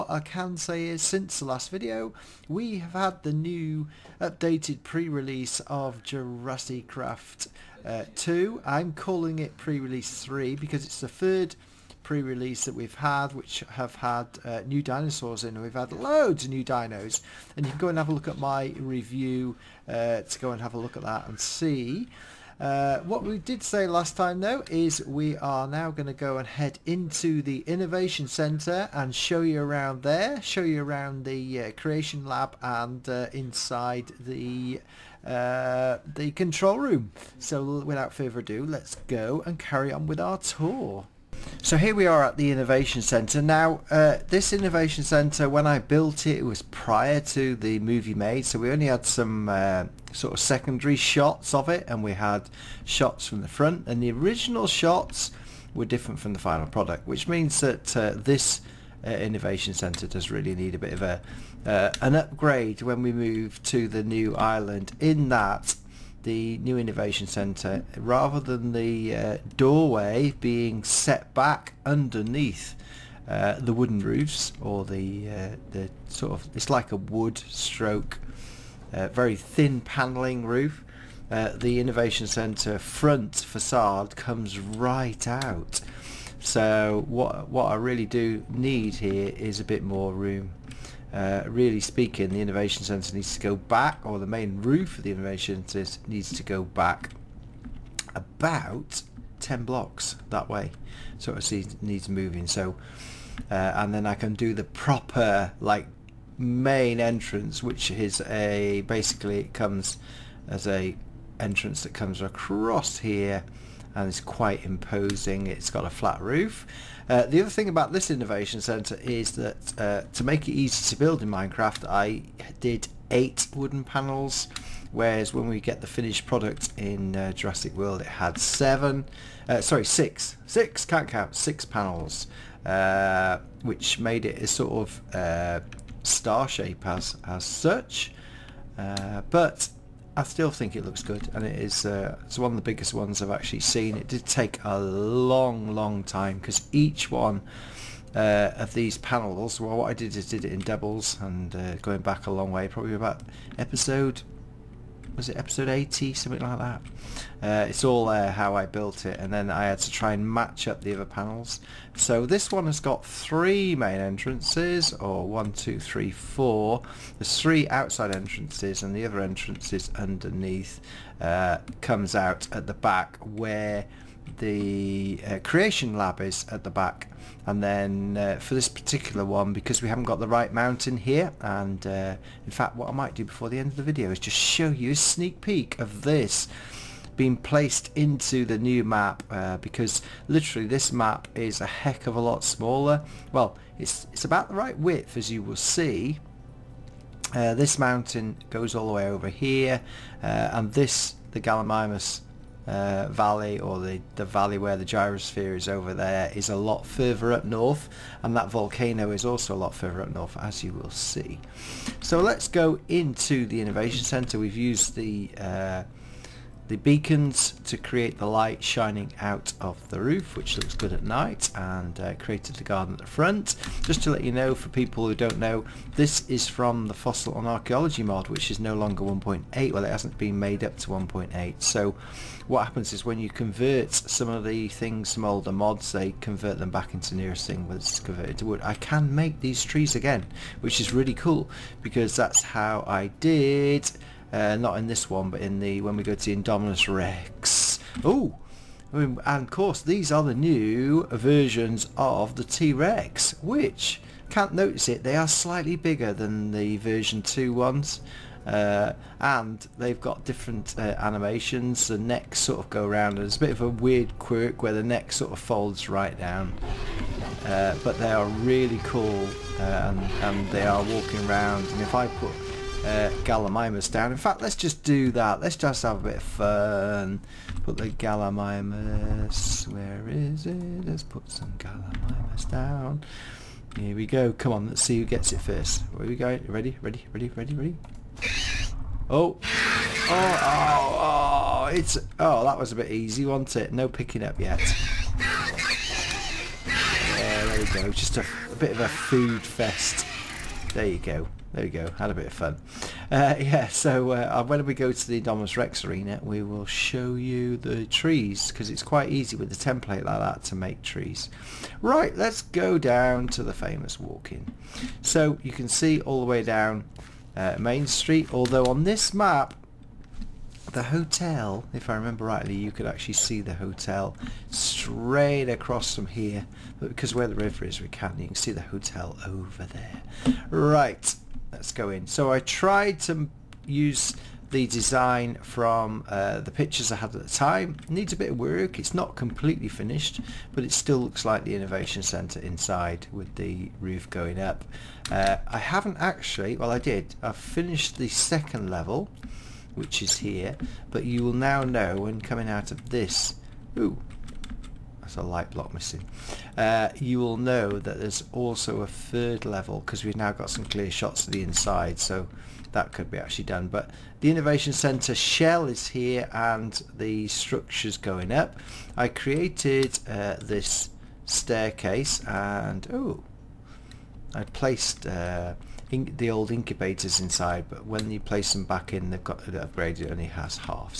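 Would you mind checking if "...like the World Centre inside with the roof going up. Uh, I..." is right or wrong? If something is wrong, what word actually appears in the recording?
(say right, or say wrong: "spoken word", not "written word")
wrong: "Innovation", not "World".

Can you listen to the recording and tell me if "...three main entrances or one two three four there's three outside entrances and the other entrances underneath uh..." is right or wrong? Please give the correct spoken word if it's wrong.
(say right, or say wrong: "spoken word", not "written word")
right.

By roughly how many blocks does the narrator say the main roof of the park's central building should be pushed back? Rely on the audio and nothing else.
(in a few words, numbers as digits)
10.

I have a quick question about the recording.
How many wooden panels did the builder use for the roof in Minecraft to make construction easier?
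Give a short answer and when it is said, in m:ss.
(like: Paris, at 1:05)
8, at 2:03.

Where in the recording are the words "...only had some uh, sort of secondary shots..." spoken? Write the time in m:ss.
0:48.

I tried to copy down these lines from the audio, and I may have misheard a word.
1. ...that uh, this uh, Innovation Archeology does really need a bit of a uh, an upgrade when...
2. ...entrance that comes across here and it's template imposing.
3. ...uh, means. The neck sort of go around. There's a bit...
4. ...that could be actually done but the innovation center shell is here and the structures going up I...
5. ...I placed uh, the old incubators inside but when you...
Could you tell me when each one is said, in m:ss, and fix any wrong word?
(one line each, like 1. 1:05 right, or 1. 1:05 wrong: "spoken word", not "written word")
1. 0:57 wrong: "Centre", not "Archeology"
2. 1:51 wrong: "quite", not "template"
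3. 4:20 wrong: "animations", not "means"
4. 6:02 right
5. 6:14 right.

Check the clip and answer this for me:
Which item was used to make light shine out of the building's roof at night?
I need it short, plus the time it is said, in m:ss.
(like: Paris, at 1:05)
Beacons, at 3:36.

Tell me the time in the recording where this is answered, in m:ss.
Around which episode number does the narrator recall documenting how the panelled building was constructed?
2:35.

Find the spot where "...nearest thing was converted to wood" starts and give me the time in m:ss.
3:57.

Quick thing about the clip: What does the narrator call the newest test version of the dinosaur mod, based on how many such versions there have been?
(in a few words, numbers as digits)
Pre-release 3.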